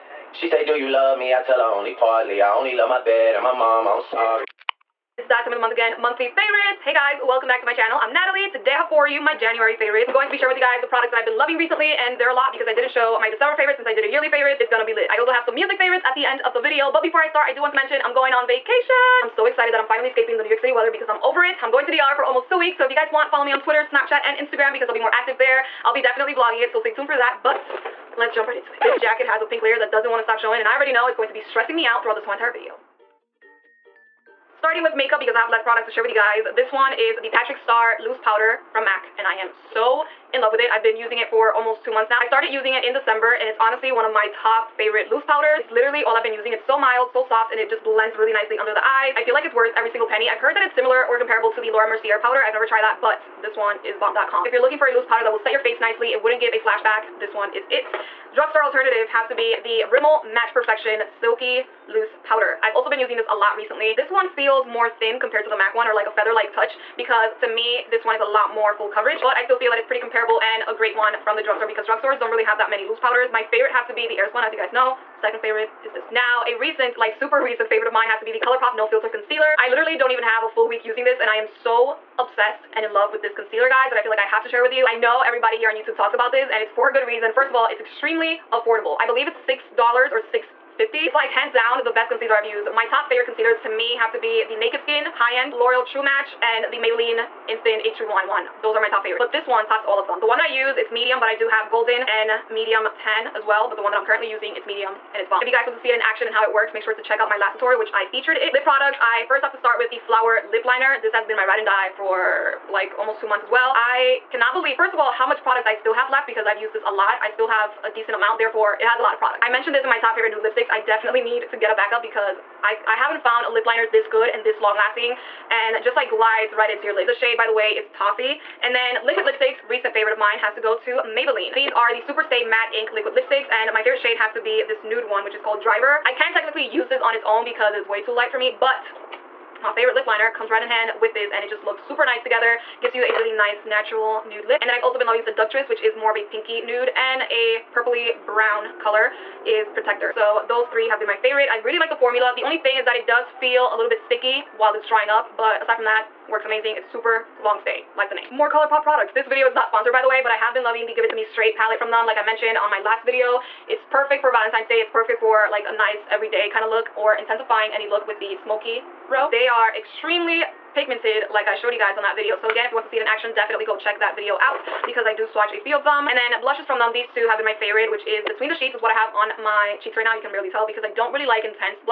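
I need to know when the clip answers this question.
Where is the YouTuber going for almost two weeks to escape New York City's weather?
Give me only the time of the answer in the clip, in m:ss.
0:21.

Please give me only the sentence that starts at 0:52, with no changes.
I've never tried that, but this one is bomb.com.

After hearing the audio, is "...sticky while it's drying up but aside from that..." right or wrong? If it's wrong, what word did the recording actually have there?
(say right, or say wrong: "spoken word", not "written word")
right.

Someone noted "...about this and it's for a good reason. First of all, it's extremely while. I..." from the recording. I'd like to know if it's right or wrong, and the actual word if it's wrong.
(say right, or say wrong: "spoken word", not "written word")
wrong: "affordable", not "while".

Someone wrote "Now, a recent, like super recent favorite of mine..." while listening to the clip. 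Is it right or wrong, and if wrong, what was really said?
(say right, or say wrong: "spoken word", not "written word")
right.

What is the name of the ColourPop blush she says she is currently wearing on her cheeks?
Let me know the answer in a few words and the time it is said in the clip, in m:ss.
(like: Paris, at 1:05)
Between the Sheets, at 2:58.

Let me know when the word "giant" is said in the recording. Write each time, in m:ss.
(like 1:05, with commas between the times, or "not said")
not said.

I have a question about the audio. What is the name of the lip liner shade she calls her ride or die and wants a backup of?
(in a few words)
Toffee.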